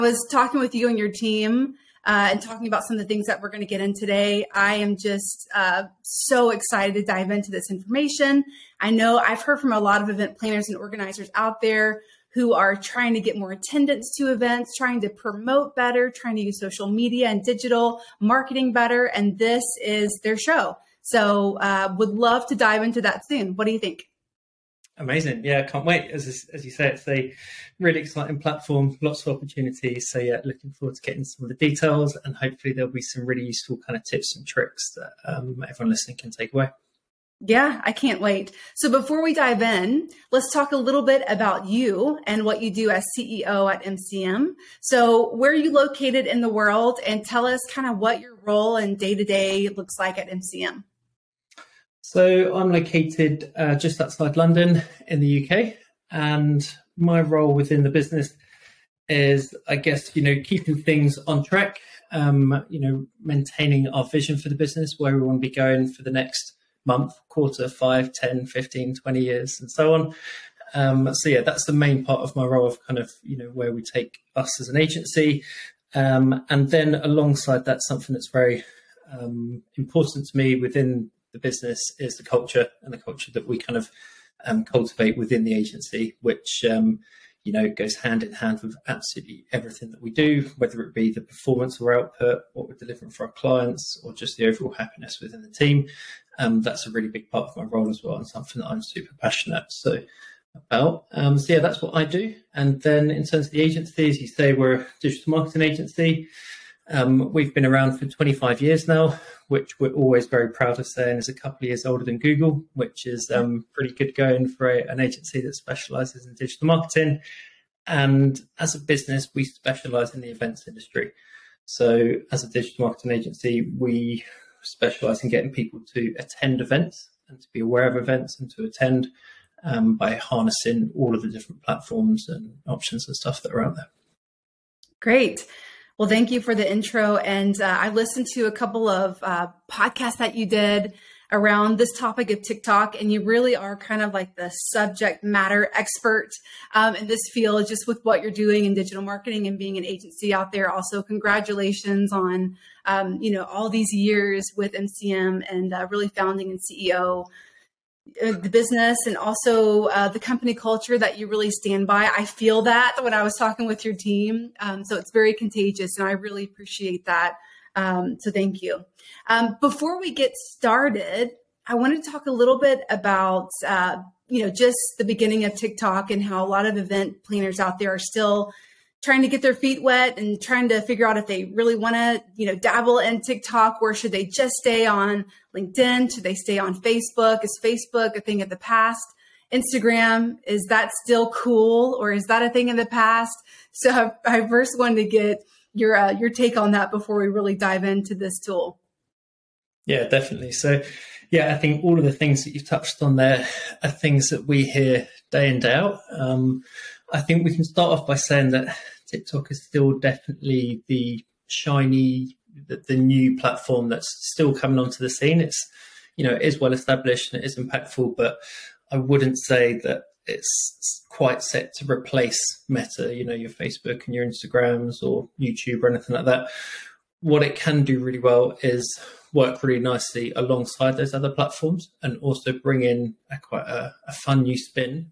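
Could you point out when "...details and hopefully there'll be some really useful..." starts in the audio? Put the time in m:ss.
0:31.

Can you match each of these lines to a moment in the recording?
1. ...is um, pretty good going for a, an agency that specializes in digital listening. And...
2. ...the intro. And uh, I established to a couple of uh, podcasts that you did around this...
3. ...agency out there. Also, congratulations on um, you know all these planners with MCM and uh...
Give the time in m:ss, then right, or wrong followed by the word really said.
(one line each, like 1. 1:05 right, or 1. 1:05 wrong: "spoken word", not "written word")
1. 1:53 wrong: "marketing", not "listening"
2. 2:16 wrong: "listened", not "established"
3. 2:29 wrong: "years", not "planners".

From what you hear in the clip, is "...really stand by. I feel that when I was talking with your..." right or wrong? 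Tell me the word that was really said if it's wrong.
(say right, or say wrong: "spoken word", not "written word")
right.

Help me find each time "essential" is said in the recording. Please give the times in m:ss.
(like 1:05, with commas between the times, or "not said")
not said.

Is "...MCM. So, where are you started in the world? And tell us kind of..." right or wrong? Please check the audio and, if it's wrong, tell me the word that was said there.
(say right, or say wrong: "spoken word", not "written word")
wrong: "located", not "started".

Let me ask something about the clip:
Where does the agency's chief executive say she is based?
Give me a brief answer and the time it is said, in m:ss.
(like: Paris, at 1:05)
Just outside London, at 0:53.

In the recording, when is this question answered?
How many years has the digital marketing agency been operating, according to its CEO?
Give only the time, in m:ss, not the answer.
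1:48.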